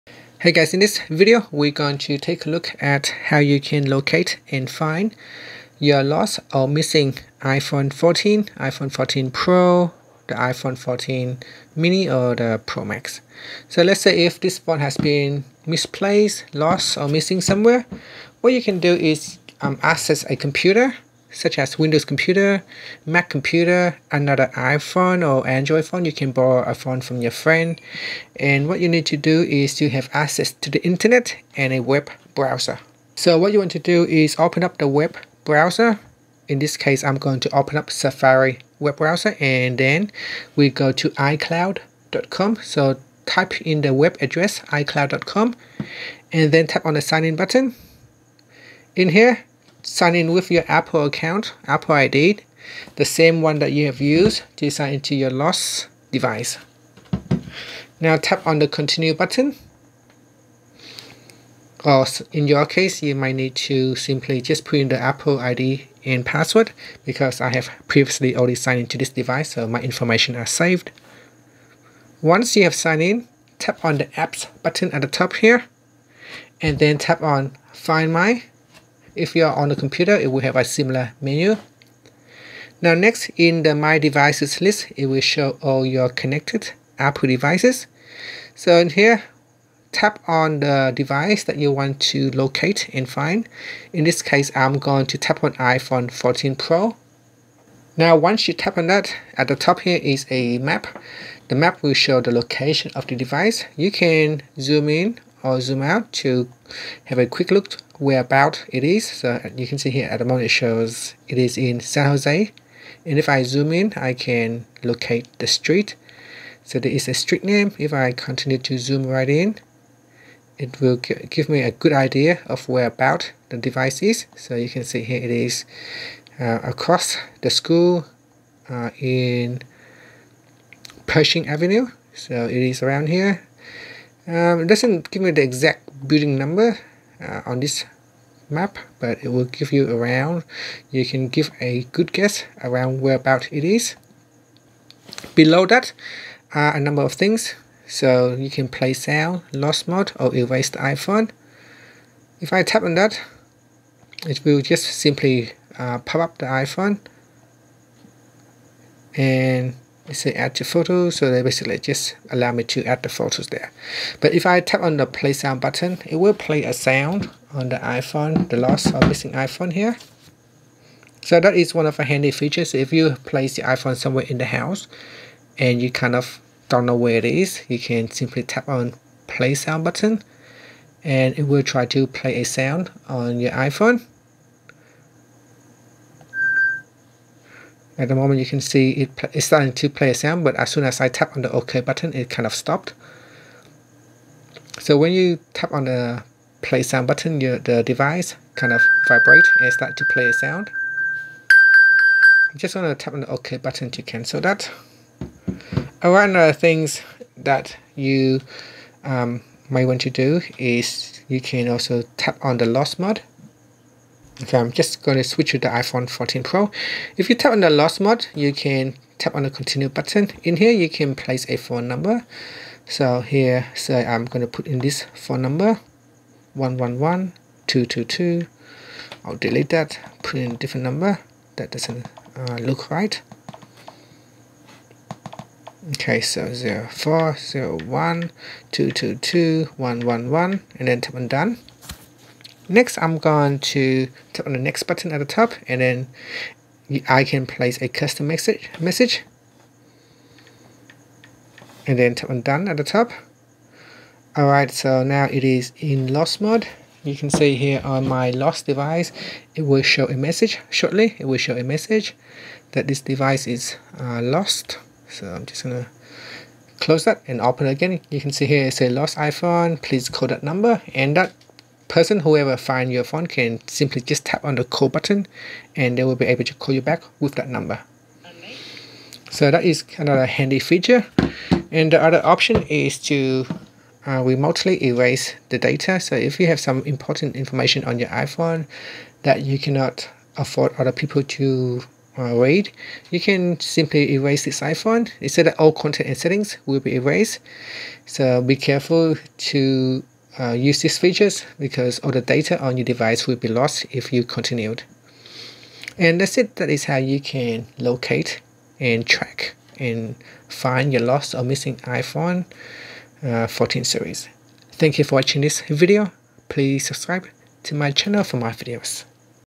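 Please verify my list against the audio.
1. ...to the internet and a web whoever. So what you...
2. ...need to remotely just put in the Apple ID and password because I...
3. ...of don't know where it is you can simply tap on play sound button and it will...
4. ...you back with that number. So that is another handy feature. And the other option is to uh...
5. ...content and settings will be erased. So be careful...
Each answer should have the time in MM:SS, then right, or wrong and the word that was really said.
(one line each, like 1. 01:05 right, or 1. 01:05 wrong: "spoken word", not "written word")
1. 00:30 wrong: "browser", not "whoever"
2. 01:03 wrong: "simply", not "remotely"
3. 02:56 right
4. 04:36 right
5. 04:55 right.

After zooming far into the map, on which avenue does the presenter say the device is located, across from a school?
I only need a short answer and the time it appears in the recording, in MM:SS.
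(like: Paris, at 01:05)
Pershing Avenue, at 02:11.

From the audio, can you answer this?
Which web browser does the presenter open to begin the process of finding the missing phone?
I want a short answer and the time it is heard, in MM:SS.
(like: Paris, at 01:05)
Safari, at 00:37.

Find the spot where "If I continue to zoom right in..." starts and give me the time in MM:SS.
01:57.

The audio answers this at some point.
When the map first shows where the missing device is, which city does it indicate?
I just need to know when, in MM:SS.
01:51.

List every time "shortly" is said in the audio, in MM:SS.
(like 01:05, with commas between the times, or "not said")
04:20.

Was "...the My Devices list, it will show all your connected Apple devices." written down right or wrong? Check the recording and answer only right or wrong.
right.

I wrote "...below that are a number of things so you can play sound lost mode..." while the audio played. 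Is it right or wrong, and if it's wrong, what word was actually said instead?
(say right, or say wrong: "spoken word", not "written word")
right.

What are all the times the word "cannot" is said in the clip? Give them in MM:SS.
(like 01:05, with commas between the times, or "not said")
04:49.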